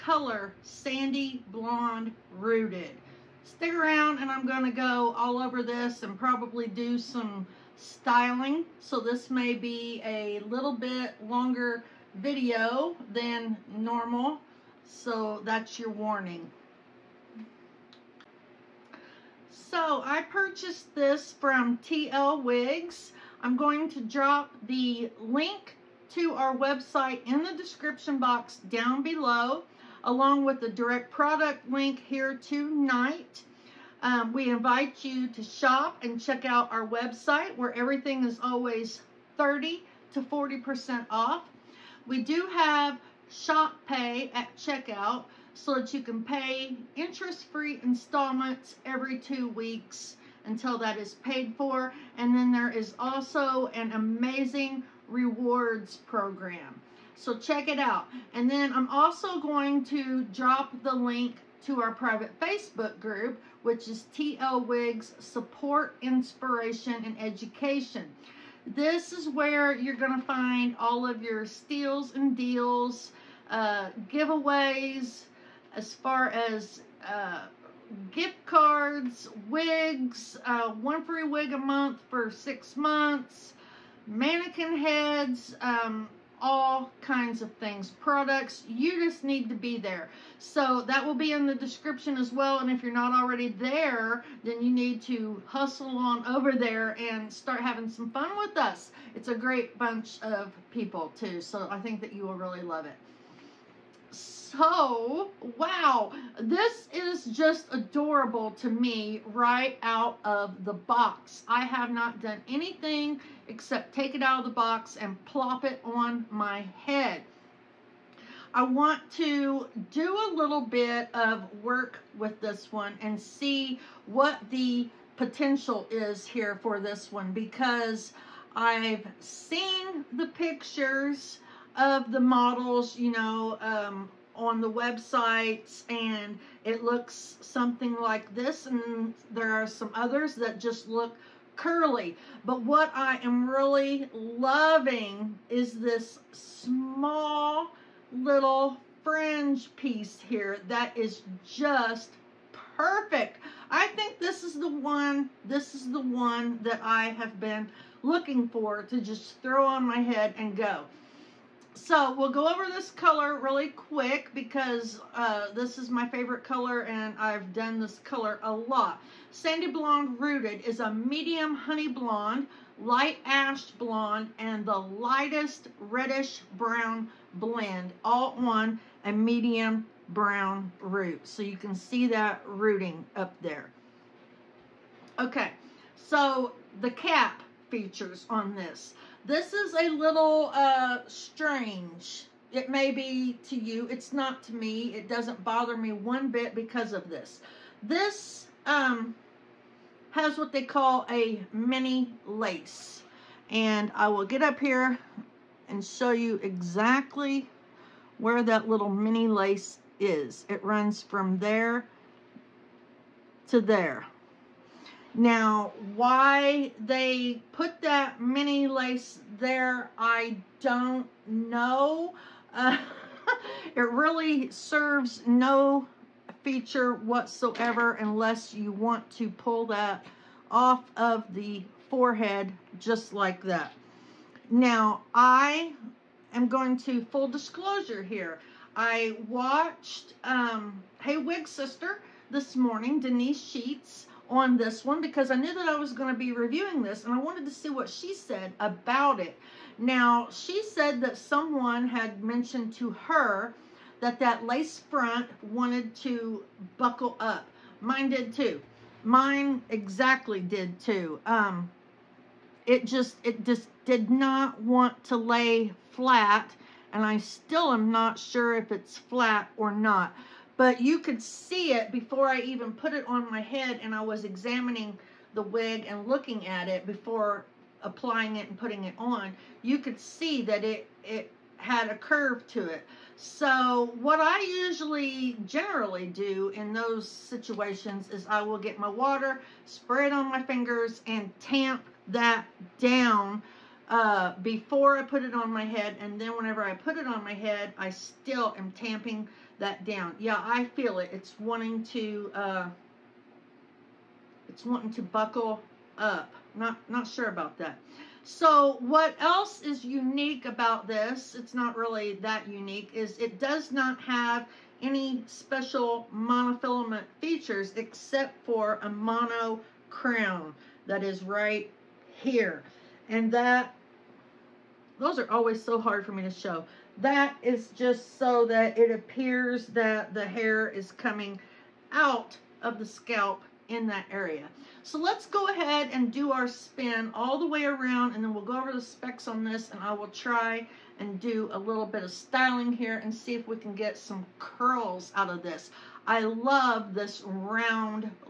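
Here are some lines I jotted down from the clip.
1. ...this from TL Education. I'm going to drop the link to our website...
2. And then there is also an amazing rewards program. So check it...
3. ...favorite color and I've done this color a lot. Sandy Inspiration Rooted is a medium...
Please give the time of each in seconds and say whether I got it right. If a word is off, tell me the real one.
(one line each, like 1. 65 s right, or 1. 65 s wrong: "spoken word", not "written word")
1. 20 s wrong: "Wigs", not "Education"
2. 52 s right
3. 166 s wrong: "Blonde", not "Inspiration".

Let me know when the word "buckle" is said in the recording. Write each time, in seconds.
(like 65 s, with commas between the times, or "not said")
256 s, 305 s.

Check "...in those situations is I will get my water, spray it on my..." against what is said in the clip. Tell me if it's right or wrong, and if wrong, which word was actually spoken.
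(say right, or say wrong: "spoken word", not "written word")
right.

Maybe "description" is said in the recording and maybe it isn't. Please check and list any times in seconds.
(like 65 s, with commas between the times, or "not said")
27 s, 91 s.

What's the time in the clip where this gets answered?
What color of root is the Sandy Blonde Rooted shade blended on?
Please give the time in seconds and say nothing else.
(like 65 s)
179 s.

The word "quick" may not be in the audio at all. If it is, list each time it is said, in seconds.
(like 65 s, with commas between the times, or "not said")
163 s.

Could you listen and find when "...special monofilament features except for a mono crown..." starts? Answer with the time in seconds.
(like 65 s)
315 s.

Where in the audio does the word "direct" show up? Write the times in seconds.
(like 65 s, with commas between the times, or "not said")
30 s.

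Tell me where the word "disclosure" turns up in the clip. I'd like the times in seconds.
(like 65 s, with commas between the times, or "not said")
237 s.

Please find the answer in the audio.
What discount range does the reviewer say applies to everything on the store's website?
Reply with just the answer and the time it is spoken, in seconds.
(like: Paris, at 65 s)
30 to 40%, at 39 s.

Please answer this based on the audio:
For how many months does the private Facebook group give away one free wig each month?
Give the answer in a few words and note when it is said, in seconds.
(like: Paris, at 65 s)
6, at 82 s.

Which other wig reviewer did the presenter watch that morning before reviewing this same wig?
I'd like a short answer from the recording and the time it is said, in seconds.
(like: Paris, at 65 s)
Denise Sheets, at 242 s.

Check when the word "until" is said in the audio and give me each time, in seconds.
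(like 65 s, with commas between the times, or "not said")
50 s.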